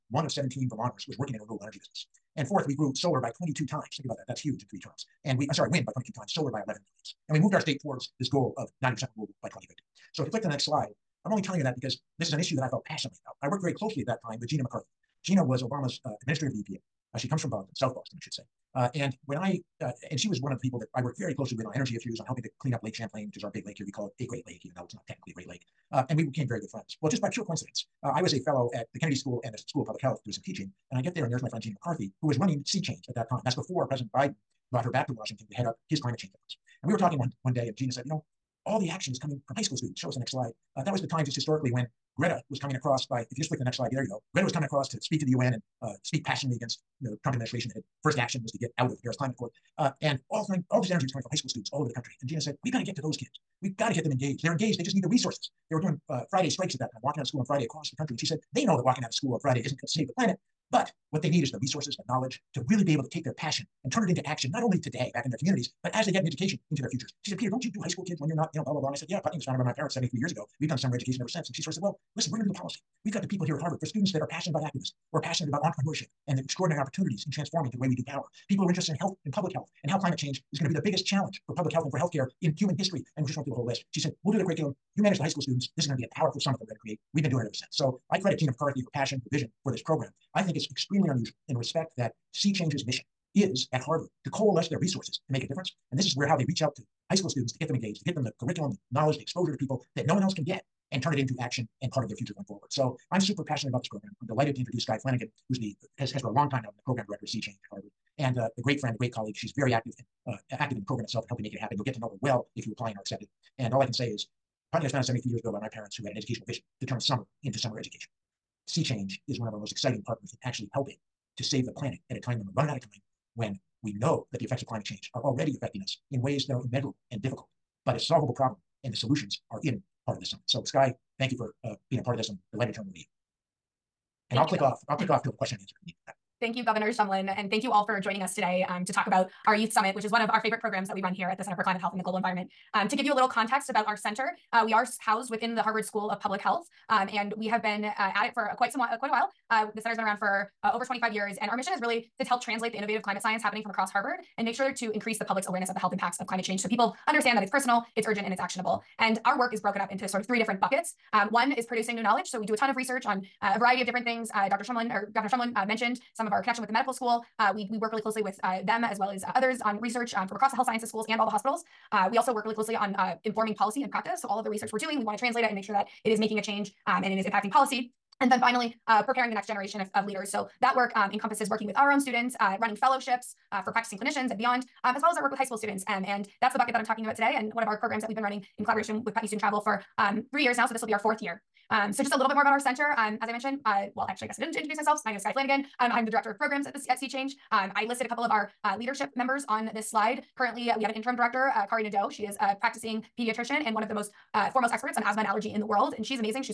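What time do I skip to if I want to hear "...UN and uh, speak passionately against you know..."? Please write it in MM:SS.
00:45.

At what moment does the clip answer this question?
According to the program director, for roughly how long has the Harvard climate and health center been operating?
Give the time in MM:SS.
02:30.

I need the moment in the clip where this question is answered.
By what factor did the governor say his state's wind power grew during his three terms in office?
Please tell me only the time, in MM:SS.
00:05.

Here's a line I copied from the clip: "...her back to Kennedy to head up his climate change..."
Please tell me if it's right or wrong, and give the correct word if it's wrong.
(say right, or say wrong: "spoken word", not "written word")
wrong: "Washington", not "Kennedy".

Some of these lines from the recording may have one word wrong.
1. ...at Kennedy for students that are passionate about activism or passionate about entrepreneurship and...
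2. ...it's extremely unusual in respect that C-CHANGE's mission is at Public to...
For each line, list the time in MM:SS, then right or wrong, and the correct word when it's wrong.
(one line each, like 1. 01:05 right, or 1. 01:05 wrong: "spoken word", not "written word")
1. 01:13 wrong: "Harvard", not "Kennedy"
2. 01:30 wrong: "Harvard", not "Public".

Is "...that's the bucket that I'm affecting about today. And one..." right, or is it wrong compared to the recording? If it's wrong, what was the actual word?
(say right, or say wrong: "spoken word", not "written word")
wrong: "talking", not "affecting".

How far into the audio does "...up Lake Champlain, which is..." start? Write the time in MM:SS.
00:22.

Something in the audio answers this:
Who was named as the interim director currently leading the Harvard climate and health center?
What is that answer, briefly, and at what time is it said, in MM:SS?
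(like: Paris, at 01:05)
Kari Nadeau, at 03:21.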